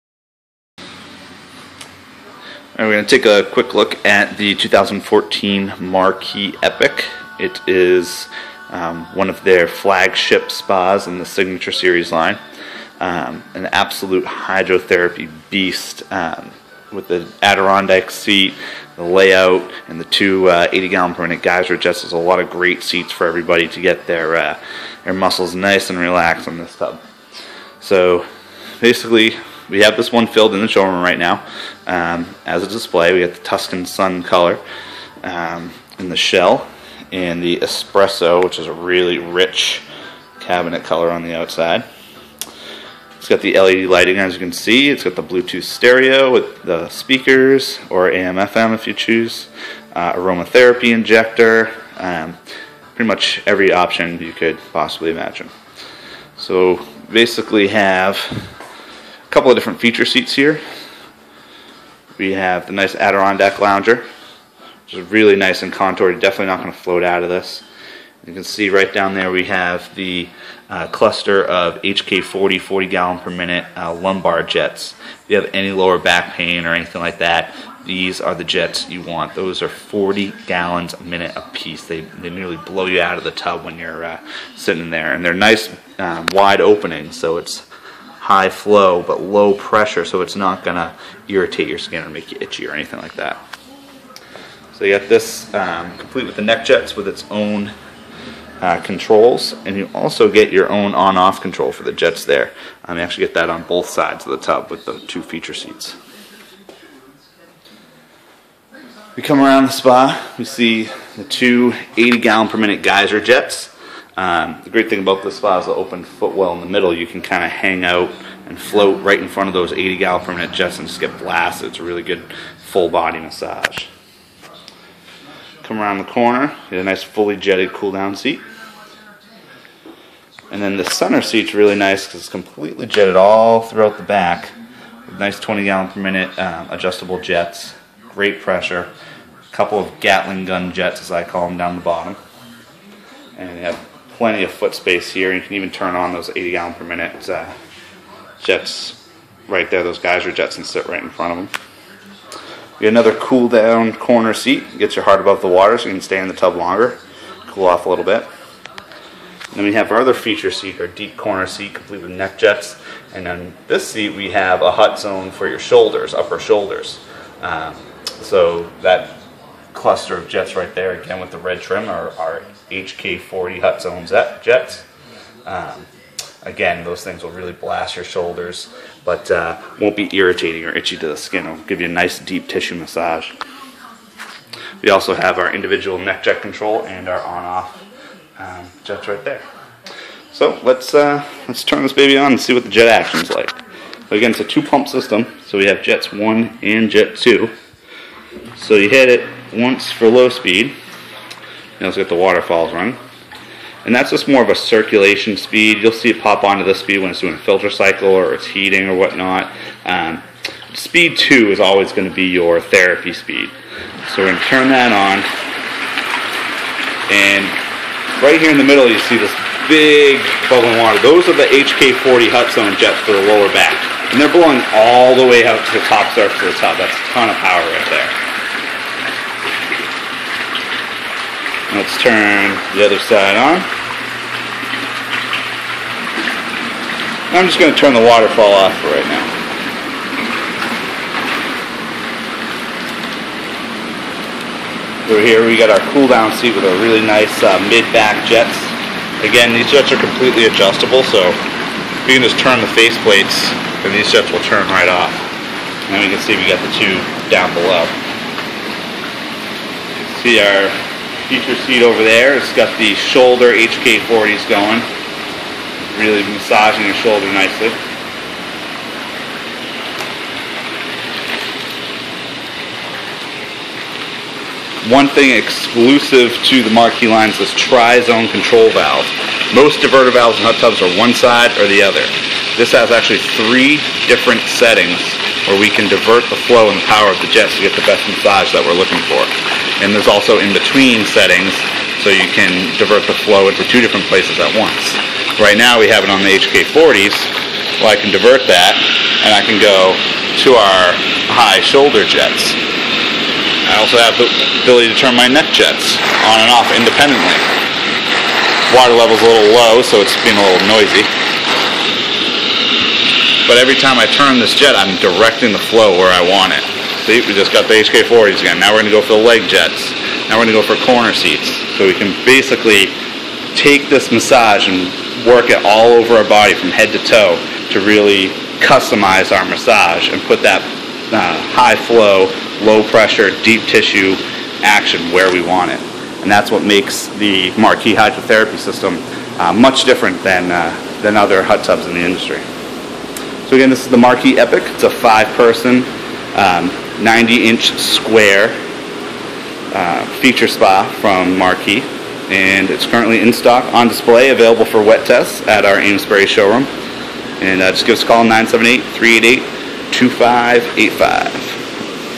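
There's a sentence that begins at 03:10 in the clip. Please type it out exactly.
So let's uh, let's turn this baby on and see what the jet action is like.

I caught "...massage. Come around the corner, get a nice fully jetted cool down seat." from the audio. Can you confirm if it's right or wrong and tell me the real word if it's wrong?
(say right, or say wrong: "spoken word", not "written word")
right.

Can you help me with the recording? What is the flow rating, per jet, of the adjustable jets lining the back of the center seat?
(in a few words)
20 gallons per minute.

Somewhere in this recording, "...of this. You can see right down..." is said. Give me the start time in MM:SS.
01:07.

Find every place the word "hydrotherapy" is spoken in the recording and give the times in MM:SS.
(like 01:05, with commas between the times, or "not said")
00:14, 05:37.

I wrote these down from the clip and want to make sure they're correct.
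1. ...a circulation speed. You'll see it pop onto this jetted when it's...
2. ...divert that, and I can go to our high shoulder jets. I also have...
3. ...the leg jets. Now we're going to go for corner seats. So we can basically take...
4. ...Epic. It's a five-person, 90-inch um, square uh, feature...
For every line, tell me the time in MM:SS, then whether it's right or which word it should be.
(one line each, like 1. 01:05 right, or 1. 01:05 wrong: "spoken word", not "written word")
1. 03:24 wrong: "speed", not "jetted"
2. 04:58 right
3. 05:19 right
4. 05:44 right.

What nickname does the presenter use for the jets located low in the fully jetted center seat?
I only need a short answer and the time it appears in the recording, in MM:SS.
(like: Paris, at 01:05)
Gatling gun jets, at 02:20.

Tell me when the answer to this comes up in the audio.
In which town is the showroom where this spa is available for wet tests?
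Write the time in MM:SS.
05:55.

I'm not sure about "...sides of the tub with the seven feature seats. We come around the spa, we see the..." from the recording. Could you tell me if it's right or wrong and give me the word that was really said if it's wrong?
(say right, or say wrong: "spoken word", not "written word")
wrong: "two", not "seven".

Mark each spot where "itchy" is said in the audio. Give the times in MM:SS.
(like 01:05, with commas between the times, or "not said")
01:32, 03:00.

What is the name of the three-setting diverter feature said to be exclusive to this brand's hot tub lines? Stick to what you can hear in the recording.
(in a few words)
tri-zone control valve.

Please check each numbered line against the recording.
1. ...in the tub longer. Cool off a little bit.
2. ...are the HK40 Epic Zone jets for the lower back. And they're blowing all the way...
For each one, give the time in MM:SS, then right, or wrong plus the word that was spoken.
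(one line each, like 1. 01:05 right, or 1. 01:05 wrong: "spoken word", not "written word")
1. 02:36 right
2. 03:41 wrong: "Hot", not "Epic".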